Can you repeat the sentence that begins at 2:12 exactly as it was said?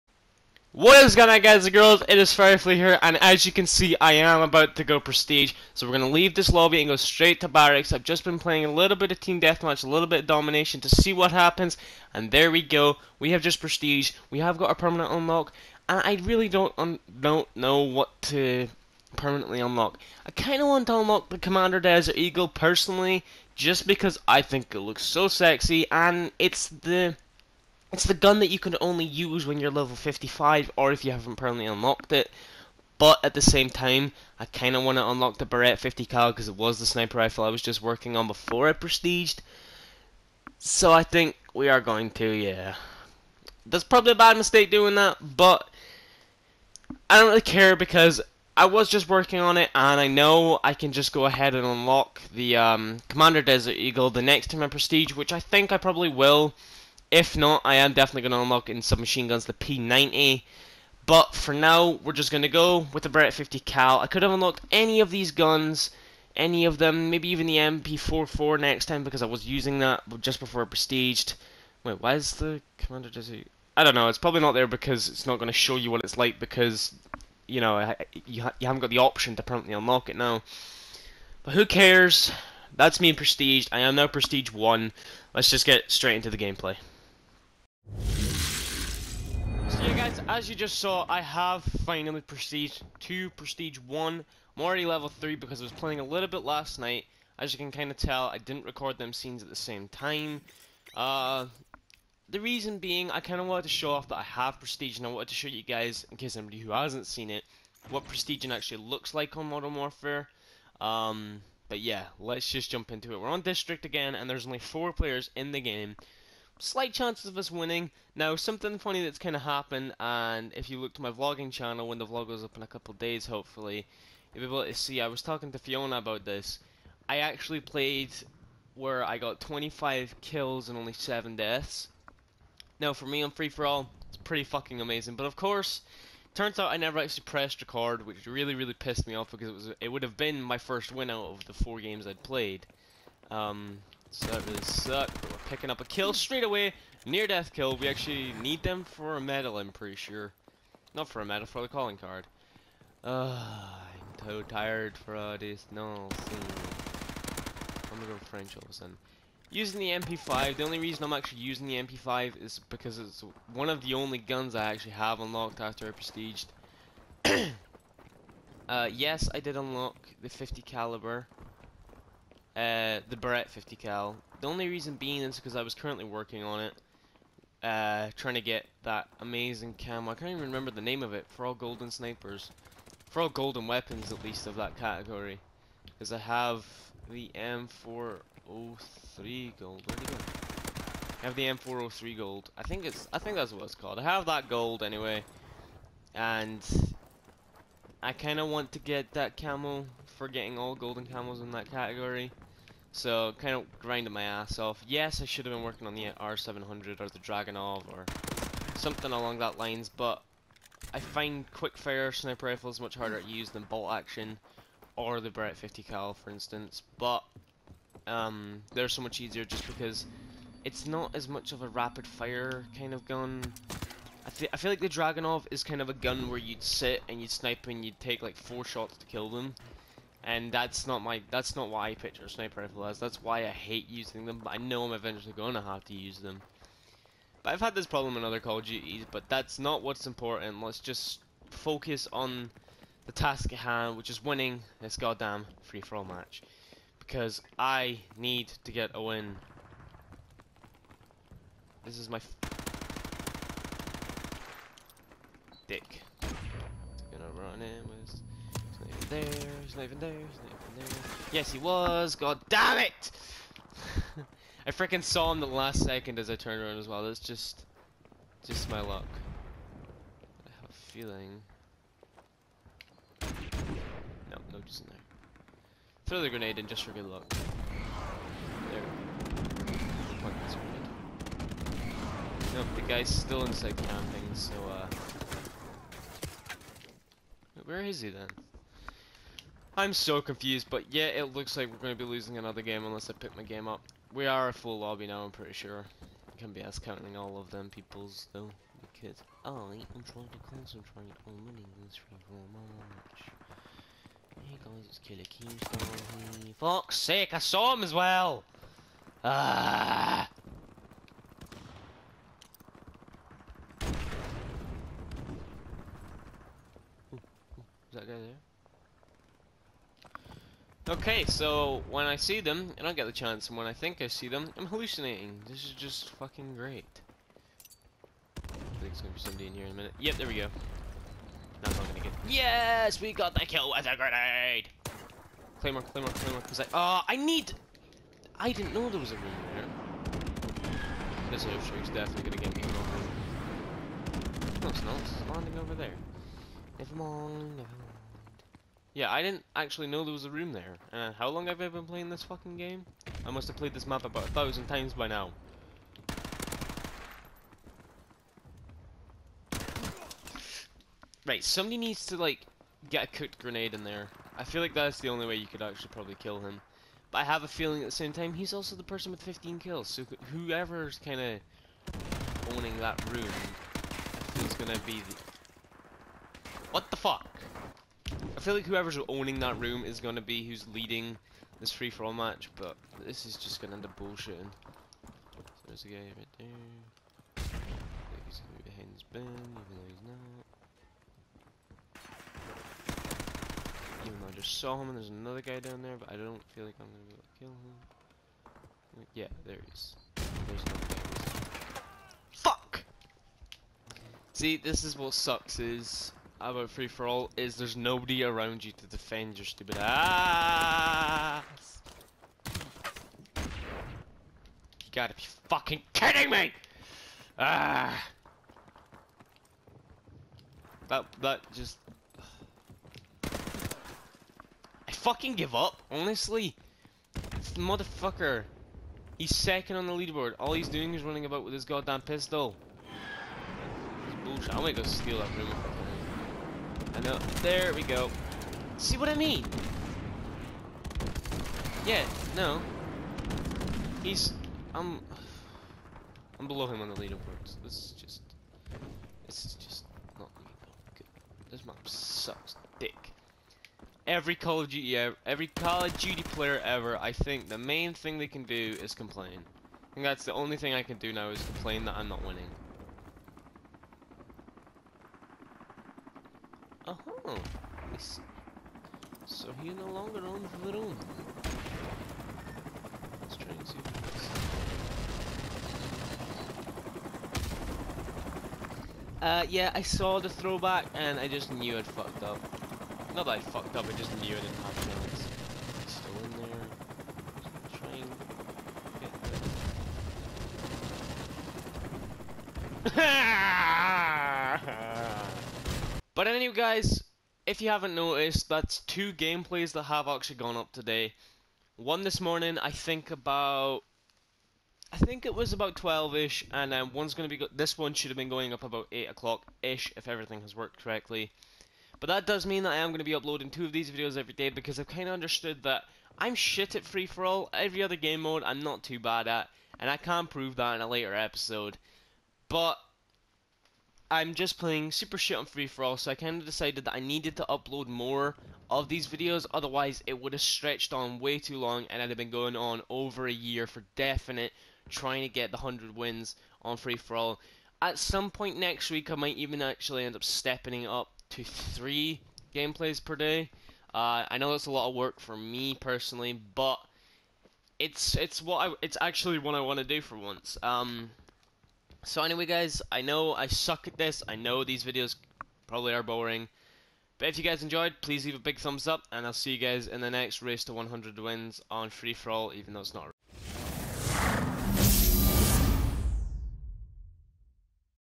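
Now, for me on Free For All, it's pretty fucking amazing.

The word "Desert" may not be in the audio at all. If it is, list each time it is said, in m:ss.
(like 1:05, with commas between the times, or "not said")
0:21, 0:53, 1:13.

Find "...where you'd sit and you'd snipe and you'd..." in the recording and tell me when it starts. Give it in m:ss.
3:46.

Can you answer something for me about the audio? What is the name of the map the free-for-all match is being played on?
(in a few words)
District.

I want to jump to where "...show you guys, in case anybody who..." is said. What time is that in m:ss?
1:45.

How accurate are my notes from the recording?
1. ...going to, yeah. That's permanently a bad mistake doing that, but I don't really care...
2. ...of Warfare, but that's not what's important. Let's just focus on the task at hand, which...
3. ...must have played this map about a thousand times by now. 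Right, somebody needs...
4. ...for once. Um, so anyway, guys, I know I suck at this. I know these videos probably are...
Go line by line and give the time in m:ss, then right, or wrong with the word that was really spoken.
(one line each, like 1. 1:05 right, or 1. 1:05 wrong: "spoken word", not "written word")
1. 0:41 wrong: "probably", not "permanently"
2. 3:58 wrong: "Duties", not "Warfare"
3. 5:53 right
4. 9:10 right.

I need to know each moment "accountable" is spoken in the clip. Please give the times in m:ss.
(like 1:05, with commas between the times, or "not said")
not said.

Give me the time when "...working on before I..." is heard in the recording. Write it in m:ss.
0:37.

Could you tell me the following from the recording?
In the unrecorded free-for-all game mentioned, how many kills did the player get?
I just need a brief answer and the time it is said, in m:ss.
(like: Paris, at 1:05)
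25, at 2:09.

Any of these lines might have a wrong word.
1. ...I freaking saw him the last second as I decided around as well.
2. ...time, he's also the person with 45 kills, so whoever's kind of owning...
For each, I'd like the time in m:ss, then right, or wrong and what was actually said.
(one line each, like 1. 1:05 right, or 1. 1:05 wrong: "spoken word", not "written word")
1. 4:24 wrong: "turned", not "decided"
2. 6:08 wrong: "15", not "45".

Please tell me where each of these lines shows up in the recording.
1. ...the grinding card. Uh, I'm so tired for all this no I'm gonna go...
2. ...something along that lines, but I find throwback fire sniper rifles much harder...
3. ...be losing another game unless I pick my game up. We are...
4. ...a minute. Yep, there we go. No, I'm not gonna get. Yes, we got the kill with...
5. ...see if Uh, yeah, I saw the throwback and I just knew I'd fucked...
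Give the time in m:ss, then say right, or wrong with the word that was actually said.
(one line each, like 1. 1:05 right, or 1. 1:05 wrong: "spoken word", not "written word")
1. 2:31 wrong: "calling", not "grinding"
2. 3:28 wrong: "quick", not "throwback"
3. 4:52 right
4. 5:29 right
5. 7:53 right.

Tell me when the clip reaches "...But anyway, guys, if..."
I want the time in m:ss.
8:16.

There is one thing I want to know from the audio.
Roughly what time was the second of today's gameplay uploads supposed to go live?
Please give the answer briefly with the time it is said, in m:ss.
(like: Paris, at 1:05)
8 o'clock, at 8:28.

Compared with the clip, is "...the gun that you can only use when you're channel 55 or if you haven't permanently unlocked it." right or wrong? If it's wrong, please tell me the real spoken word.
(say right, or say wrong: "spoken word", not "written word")
wrong: "level", not "channel".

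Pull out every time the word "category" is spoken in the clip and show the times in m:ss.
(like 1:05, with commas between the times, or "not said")
3:04, 3:21.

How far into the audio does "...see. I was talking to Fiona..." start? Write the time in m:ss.
2:04.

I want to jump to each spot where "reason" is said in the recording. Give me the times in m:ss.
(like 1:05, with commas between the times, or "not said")
1:42, 2:40, 2:54.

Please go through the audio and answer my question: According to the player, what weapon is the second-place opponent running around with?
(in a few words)
pistol.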